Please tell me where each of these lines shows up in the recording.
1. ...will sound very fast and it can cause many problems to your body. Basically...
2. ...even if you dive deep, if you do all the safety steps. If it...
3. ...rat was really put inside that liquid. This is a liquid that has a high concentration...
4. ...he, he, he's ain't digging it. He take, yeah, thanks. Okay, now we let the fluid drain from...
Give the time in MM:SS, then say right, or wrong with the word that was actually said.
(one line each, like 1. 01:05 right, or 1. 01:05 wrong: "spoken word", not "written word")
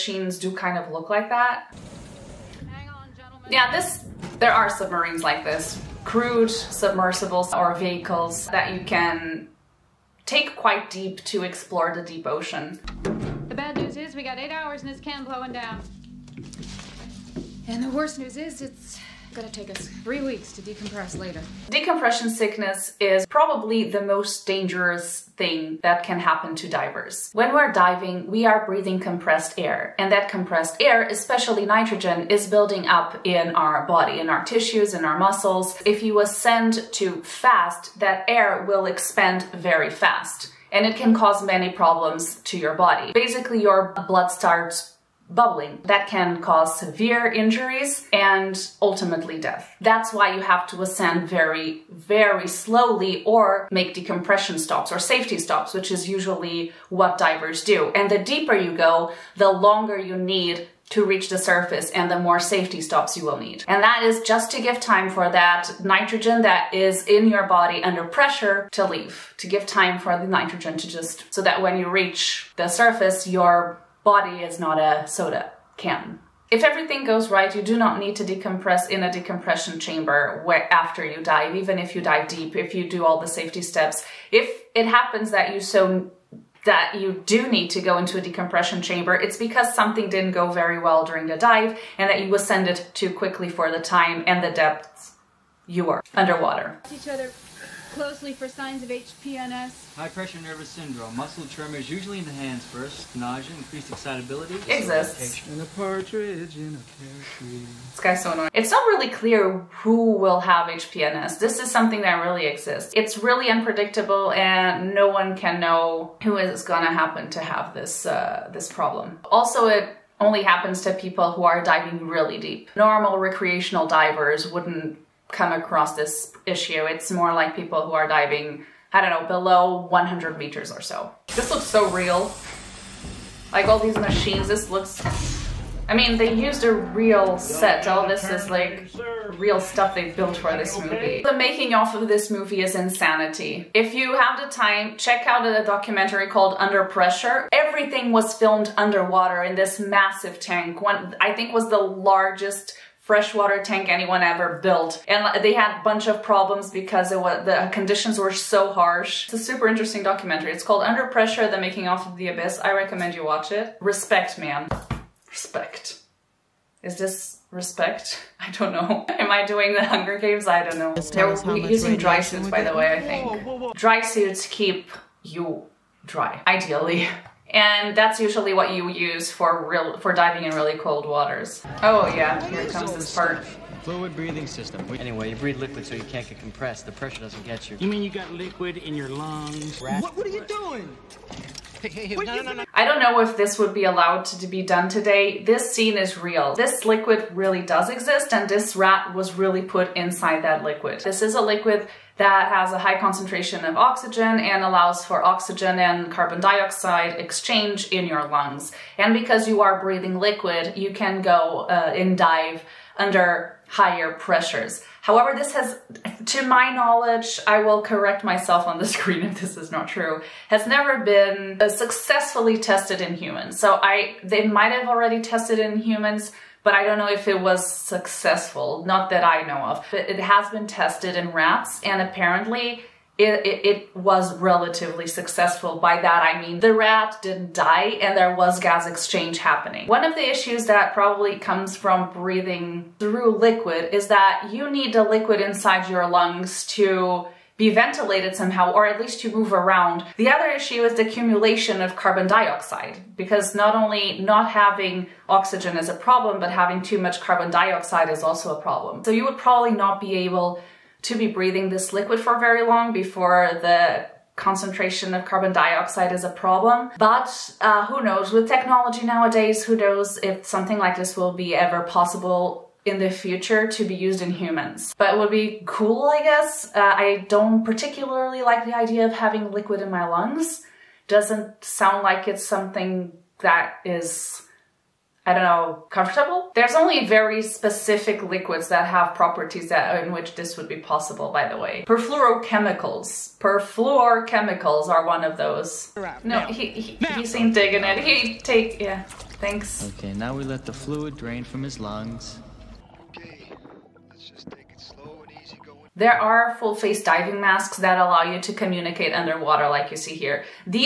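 1. 00:38 wrong: "expand", not "sound"
2. 01:21 right
3. 03:18 right
4. 04:56 right.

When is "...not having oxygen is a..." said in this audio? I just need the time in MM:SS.
04:14.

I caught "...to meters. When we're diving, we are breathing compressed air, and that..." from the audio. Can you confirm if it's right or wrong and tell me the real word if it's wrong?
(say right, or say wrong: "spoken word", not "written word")
wrong: "divers", not "meters".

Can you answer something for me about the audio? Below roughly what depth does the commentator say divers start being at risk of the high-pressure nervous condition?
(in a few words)
100 meters.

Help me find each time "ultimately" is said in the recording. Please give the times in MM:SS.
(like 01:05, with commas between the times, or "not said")
00:48.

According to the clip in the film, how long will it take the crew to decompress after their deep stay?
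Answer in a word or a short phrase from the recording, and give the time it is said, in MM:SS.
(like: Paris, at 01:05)
3 weeks, at 00:20.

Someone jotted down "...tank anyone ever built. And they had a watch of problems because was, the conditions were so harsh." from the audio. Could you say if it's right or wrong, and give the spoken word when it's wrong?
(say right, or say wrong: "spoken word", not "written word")
wrong: "bunch", not "watch".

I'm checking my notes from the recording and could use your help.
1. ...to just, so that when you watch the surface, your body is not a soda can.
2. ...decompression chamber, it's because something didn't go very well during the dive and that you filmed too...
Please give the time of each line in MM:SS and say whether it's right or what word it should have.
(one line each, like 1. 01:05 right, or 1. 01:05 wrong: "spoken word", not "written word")
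1. 01:10 wrong: "reach", not "watch"
2. 01:28 wrong: "ascended", not "filmed".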